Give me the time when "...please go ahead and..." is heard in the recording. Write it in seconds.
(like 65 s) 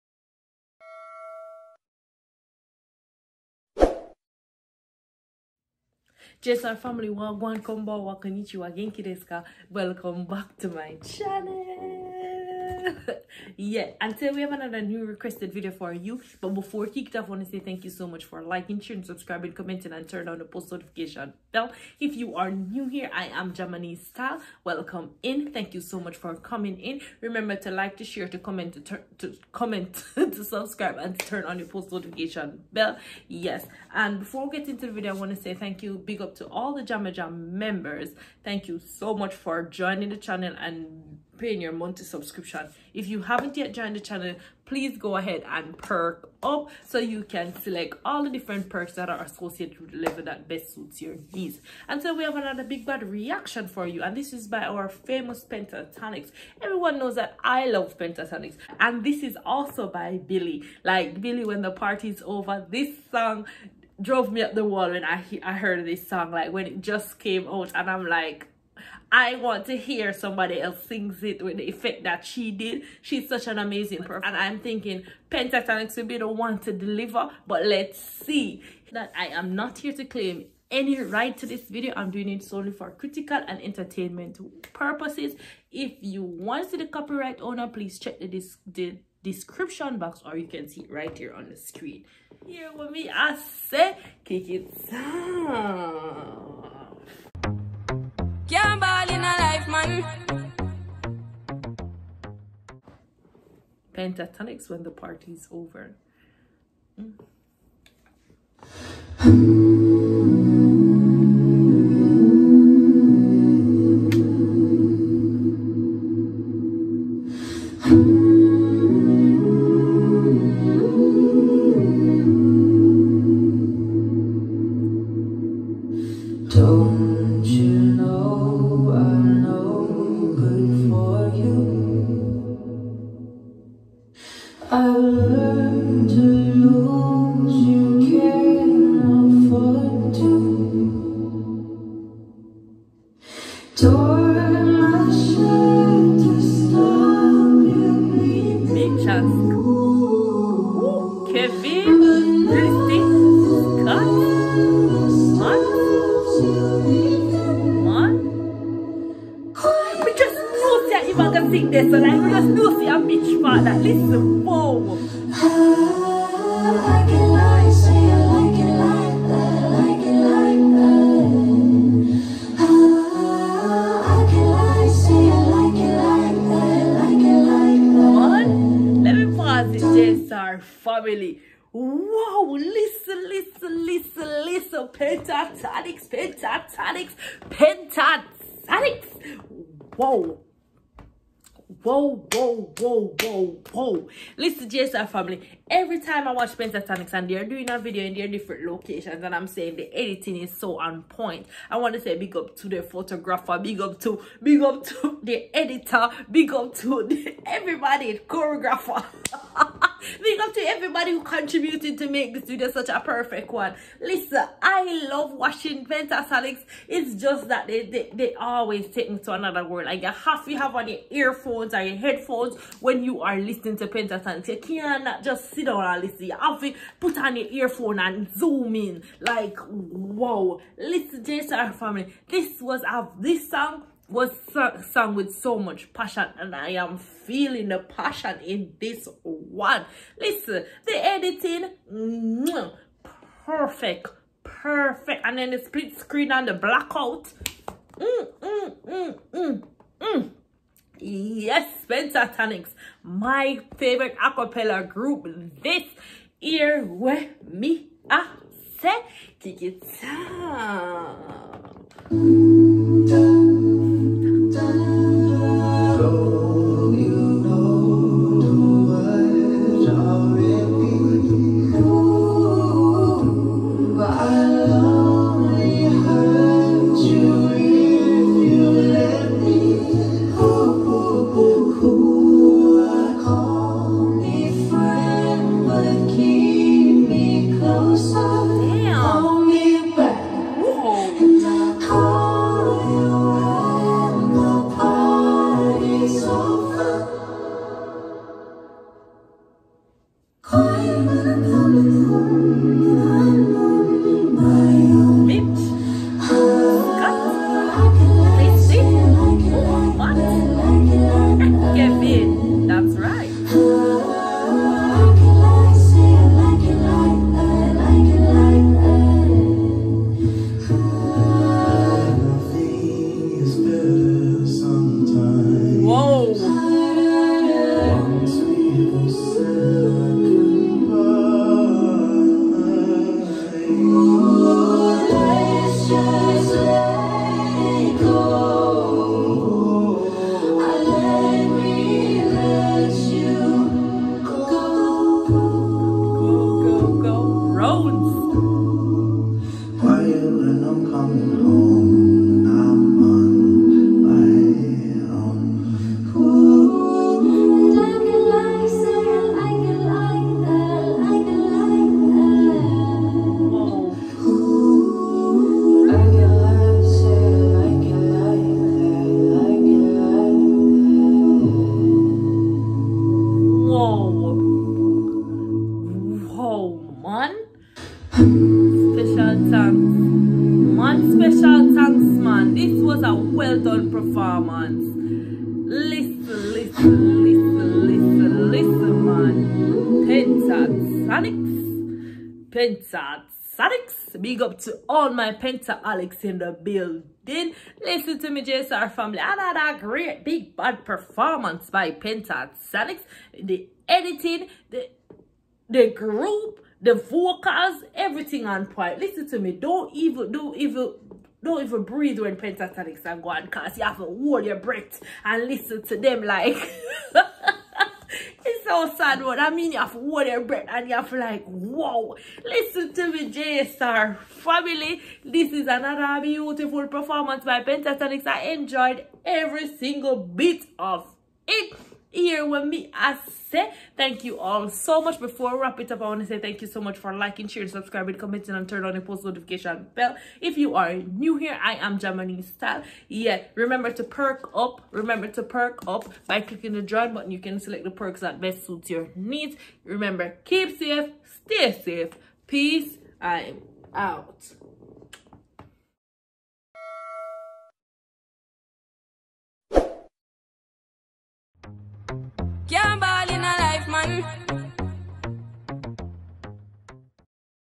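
44 s.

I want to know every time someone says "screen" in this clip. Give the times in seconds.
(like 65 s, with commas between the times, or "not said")
91 s, 245 s.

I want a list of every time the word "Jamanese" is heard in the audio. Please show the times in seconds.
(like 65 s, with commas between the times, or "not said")
23 s, 441 s.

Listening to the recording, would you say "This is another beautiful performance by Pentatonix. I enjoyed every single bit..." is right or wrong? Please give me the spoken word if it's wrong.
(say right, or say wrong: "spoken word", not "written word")
right.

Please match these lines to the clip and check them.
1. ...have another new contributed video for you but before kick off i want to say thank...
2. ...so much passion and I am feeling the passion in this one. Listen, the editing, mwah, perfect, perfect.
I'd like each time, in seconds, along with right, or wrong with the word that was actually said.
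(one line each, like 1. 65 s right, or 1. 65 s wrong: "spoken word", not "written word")
1. 14 s wrong: "requested", not "contributed"
2. 235 s right.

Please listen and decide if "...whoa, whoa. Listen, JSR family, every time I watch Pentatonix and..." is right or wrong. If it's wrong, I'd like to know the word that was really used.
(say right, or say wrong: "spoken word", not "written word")
right.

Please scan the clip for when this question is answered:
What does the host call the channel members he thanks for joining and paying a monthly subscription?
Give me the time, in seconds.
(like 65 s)
36 s.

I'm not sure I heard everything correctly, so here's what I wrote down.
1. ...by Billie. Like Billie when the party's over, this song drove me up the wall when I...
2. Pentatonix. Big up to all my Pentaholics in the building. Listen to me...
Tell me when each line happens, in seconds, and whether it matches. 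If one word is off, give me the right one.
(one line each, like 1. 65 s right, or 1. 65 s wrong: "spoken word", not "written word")
1. 59 s right
2. 392 s right.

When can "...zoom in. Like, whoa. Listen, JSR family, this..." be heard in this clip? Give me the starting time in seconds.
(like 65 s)
228 s.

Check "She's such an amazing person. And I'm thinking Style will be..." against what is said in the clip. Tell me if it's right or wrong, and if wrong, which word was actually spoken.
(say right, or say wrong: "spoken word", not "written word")
wrong: "Pentatonix", not "Style".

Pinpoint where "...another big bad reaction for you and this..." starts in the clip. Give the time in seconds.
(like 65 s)
52 s.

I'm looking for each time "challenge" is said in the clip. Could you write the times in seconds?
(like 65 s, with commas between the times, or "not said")
not said.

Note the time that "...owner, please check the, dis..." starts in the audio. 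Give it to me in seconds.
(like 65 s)
87 s.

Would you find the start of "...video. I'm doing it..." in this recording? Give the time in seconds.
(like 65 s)
81 s.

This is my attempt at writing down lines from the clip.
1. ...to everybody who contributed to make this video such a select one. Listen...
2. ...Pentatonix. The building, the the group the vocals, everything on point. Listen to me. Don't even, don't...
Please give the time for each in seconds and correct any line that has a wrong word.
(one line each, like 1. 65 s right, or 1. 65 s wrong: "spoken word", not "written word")
1. 210 s wrong: "perfect", not "select"
2. 401 s wrong: "editing", not "building".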